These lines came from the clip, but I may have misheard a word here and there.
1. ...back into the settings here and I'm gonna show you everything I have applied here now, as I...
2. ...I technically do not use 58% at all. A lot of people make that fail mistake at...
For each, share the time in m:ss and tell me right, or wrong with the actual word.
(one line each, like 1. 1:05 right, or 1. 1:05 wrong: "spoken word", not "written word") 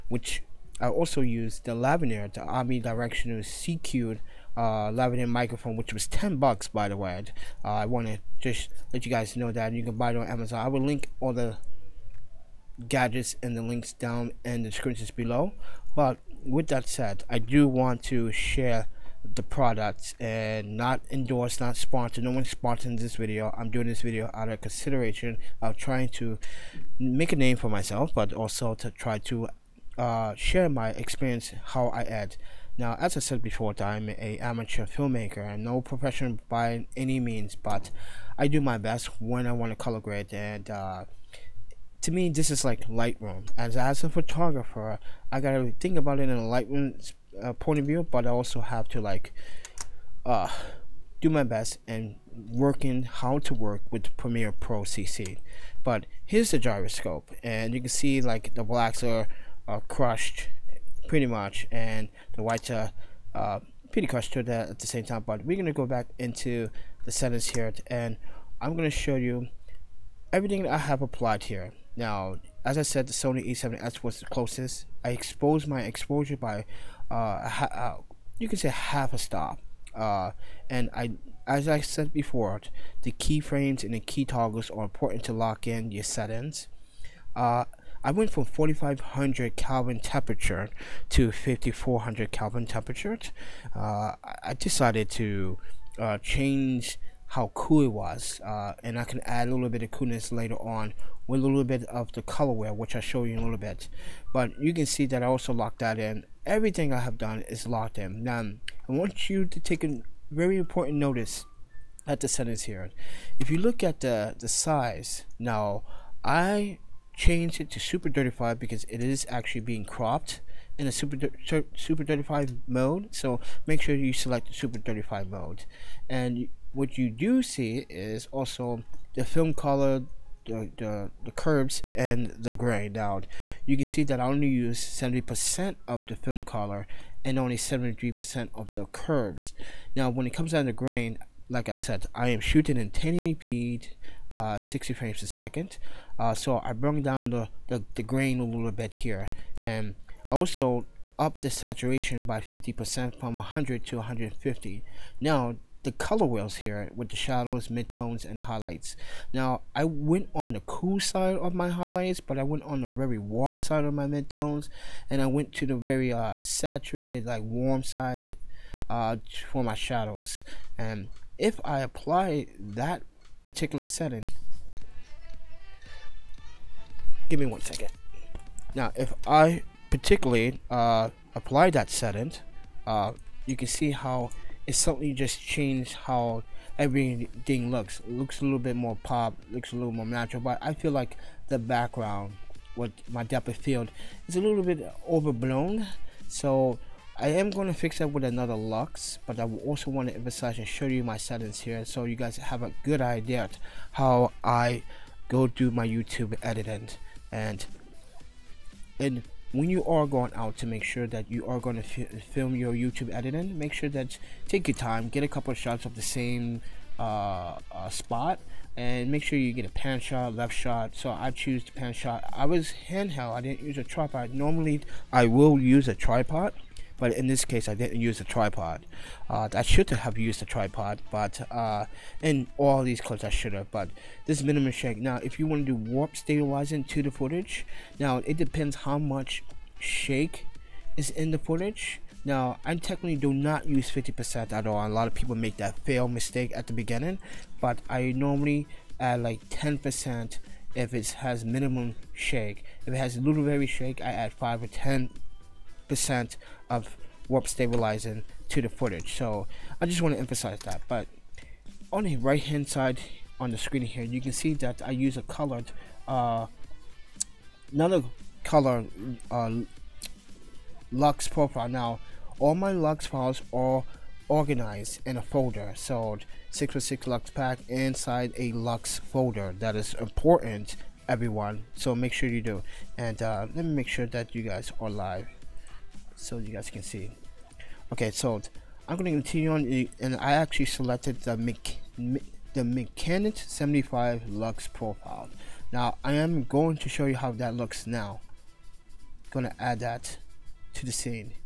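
1. 1:05 right
2. 4:02 wrong: "50", not "58".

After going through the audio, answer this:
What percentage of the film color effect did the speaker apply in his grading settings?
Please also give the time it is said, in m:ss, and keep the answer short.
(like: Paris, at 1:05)
70%, at 2:14.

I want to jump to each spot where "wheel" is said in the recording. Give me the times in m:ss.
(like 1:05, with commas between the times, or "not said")
1:42, 2:36.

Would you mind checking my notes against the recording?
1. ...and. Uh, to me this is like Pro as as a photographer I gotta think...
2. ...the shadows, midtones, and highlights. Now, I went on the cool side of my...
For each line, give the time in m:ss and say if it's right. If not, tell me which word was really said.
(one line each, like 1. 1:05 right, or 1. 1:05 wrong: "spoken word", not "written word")
1. 0:40 wrong: "Lightroom", not "Pro"
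2. 2:37 right.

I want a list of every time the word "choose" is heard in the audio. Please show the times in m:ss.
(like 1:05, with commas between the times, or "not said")
3:41.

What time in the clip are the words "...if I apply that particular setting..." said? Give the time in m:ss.
2:51.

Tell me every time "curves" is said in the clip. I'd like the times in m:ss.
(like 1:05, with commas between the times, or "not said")
2:11, 2:18.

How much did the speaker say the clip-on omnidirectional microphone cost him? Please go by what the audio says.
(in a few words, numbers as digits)
10 bucks.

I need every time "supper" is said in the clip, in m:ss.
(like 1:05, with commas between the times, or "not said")
not said.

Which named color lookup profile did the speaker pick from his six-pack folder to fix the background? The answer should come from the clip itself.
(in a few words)
mechanic 75.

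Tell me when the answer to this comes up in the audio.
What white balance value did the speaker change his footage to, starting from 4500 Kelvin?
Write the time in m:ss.
1:31.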